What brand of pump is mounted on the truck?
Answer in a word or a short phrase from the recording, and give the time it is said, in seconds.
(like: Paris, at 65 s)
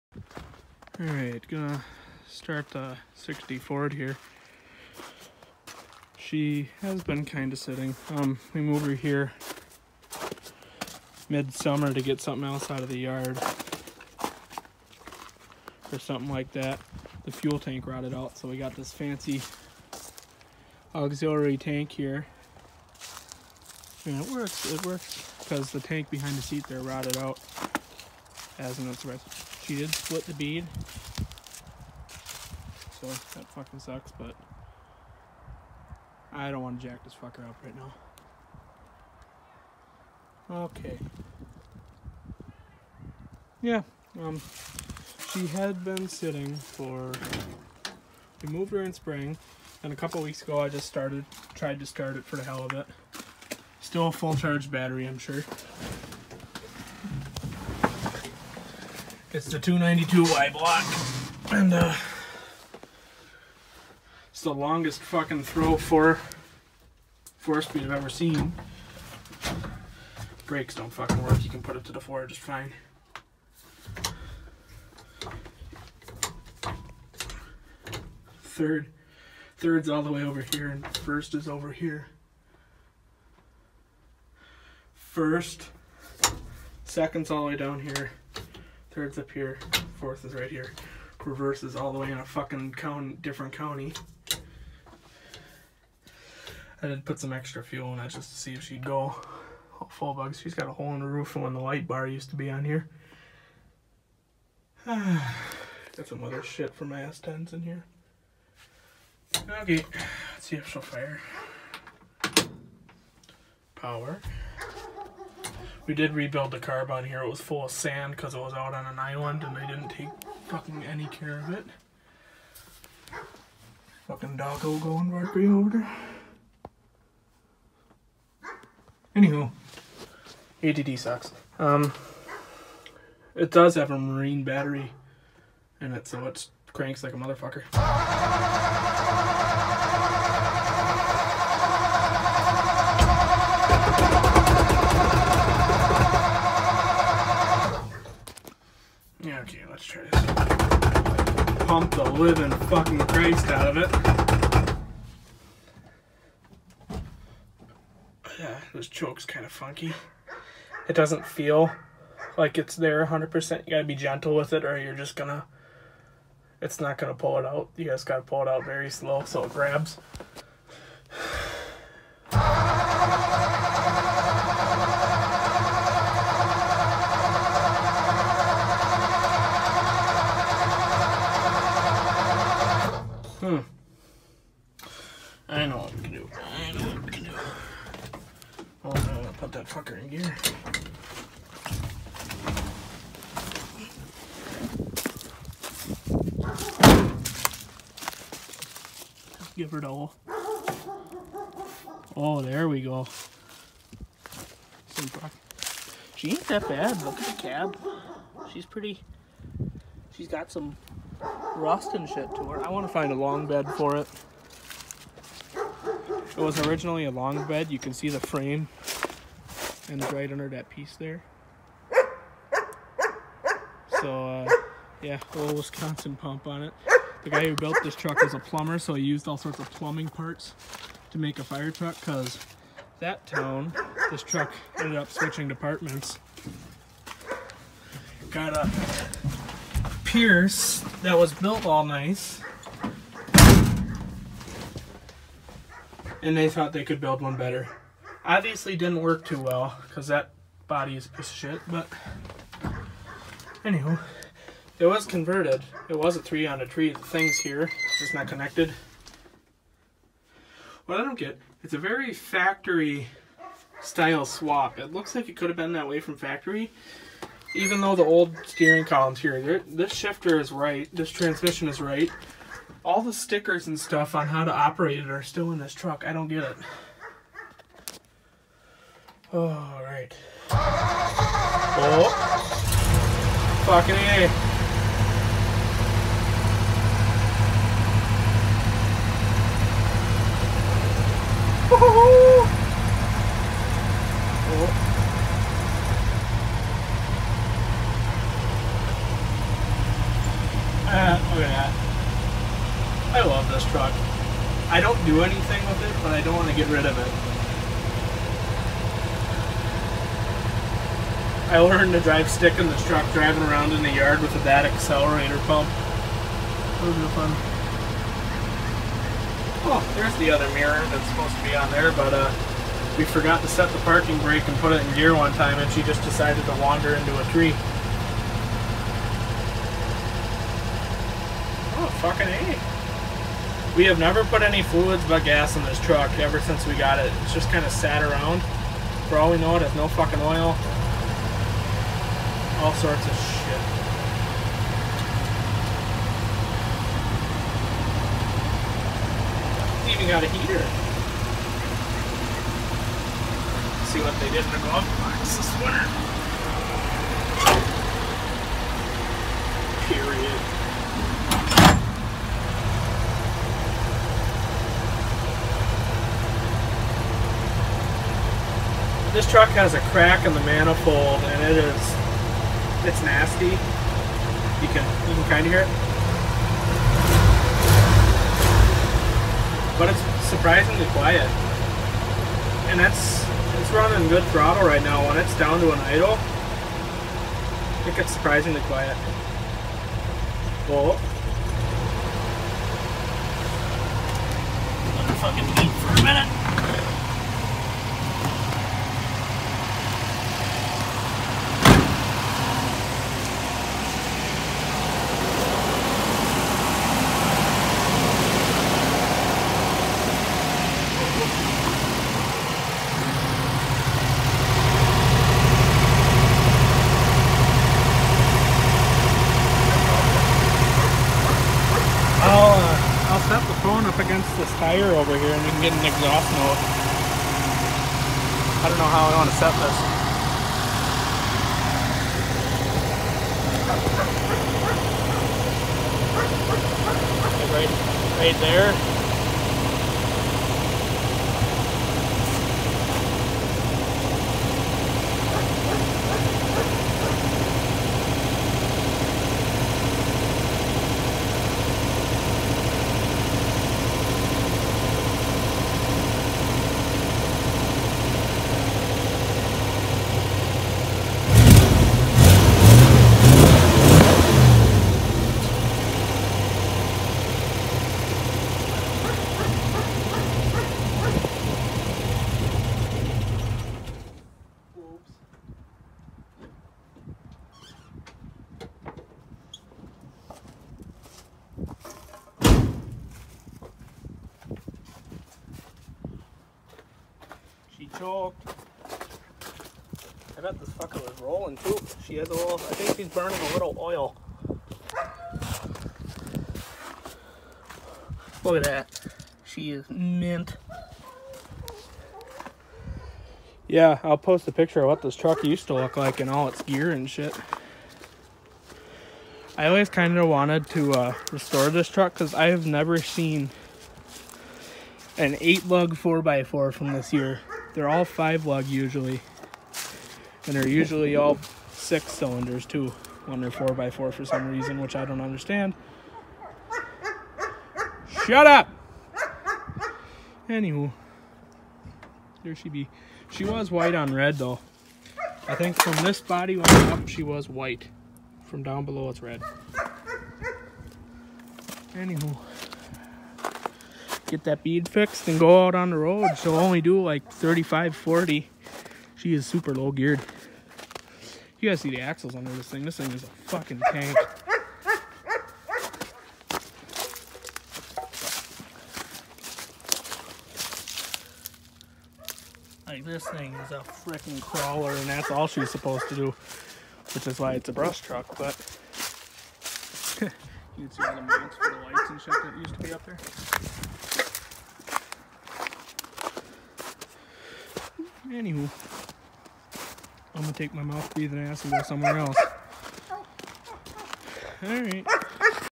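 Wisconsin, at 225 s.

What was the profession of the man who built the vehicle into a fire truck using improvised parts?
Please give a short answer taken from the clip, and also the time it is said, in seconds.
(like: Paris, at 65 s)
Plumber, at 228 s.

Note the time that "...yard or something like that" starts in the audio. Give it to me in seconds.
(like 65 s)
12 s.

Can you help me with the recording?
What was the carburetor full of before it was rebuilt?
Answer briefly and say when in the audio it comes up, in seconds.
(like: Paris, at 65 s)
Sand, at 117 s.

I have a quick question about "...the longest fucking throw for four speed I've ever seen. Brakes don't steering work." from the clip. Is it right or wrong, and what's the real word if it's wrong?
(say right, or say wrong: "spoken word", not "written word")
wrong: "fucking", not "steering".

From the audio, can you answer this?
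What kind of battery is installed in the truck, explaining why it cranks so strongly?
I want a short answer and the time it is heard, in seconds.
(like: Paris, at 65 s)
Marine battery, at 133 s.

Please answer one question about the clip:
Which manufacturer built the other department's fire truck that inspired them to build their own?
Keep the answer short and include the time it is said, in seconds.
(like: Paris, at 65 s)
Pierce, at 240 s.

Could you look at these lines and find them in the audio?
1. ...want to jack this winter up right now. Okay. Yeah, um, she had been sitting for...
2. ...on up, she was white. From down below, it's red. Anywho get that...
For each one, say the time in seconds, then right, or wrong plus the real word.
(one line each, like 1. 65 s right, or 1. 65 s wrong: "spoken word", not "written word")
1. 36 s wrong: "fucker", not "winter"
2. 536 s right.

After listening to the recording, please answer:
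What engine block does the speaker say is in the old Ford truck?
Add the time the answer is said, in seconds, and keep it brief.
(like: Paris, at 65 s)
292Y, at 59 s.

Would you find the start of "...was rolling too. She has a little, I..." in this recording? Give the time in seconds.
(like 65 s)
491 s.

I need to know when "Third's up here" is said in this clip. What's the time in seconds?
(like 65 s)
88 s.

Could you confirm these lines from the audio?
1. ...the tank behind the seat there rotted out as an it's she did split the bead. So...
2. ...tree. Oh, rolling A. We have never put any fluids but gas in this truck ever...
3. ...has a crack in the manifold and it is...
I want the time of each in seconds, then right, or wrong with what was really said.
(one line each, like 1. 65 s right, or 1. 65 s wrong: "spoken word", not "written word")
1. 25 s right
2. 327 s wrong: "fucking", not "rolling"
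3. 369 s right.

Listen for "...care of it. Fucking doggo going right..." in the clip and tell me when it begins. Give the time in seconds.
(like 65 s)
121 s.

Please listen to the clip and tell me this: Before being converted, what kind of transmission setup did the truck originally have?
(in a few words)
Three on a tree.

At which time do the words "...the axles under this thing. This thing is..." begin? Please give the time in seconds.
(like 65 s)
551 s.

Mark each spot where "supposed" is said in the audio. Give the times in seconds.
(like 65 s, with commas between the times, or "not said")
321 s, 565 s.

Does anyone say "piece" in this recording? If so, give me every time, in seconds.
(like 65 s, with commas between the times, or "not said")
220 s, 251 s.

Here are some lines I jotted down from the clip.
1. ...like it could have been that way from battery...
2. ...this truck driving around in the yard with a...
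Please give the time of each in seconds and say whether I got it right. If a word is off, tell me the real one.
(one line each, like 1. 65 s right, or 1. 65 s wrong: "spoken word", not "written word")
1. 265 s wrong: "factory", not "battery"
2. 312 s right.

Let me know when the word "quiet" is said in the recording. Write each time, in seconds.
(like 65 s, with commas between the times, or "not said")
380 s, 388 s.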